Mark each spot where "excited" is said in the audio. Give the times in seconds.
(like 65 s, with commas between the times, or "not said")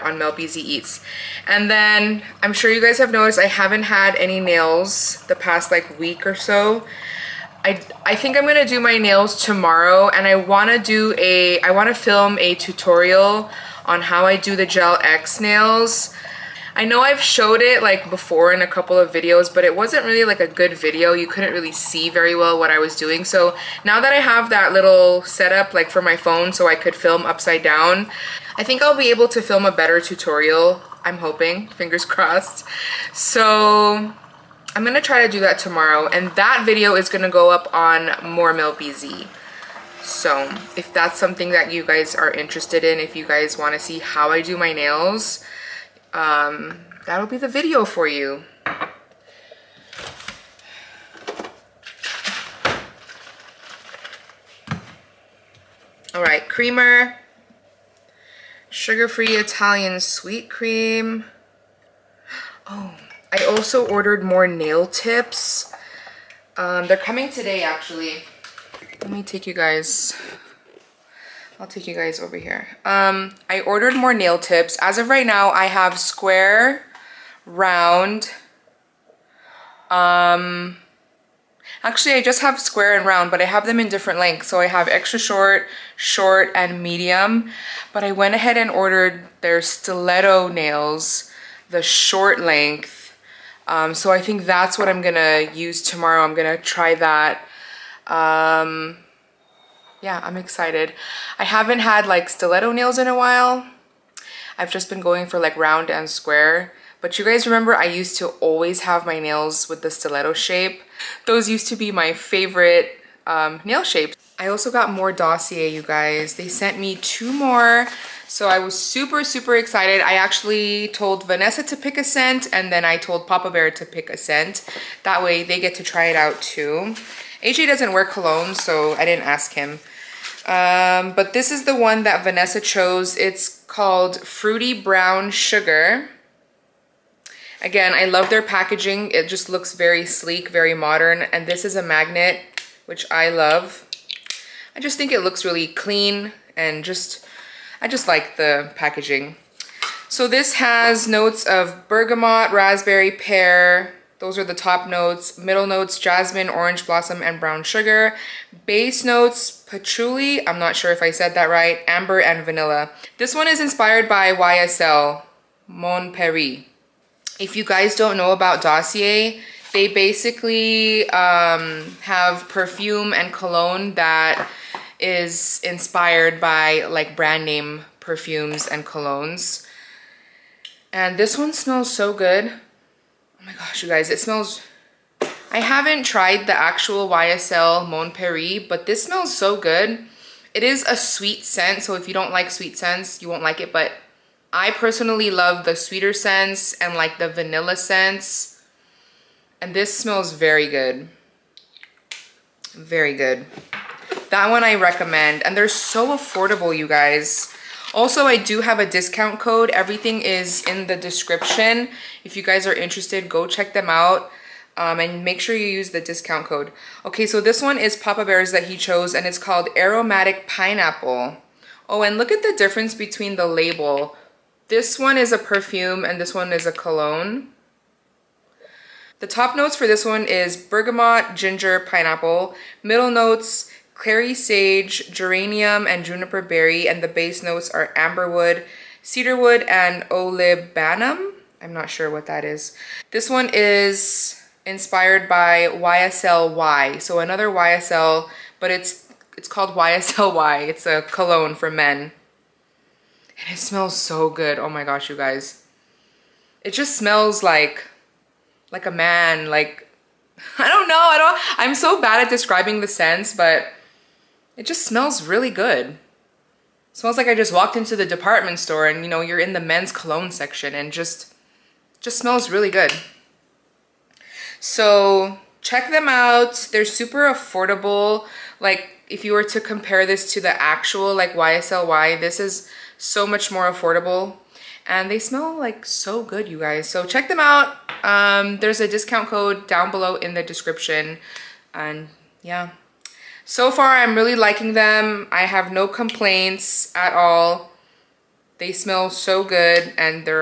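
100 s, 119 s.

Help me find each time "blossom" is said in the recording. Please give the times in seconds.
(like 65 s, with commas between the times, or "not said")
156 s.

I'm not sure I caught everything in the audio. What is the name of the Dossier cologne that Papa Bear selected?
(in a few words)
Aromatic Pineapple.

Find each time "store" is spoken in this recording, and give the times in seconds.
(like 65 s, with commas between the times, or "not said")
268 s.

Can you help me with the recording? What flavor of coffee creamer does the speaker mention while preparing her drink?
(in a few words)
Sugar-free Italian sweet cream.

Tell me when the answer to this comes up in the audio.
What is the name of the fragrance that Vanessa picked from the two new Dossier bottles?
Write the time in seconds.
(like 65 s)
134 s.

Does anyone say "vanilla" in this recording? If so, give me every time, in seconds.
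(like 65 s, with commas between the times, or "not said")
162 s, 197 s.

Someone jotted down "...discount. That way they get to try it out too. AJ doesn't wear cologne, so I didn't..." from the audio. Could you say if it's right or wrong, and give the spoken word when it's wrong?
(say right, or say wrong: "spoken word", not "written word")
wrong: "scent", not "discount".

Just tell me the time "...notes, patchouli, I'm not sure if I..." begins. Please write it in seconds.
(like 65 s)
159 s.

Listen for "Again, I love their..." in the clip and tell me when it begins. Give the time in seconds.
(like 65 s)
137 s.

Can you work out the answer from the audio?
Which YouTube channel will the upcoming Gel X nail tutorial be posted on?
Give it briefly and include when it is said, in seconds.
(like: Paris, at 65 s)
More Mel Beezee, at 38 s.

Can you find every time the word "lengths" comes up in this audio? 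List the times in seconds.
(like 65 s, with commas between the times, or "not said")
84 s, 92 s.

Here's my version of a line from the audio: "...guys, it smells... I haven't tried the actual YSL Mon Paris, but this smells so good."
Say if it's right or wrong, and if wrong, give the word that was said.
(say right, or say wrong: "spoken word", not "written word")
right.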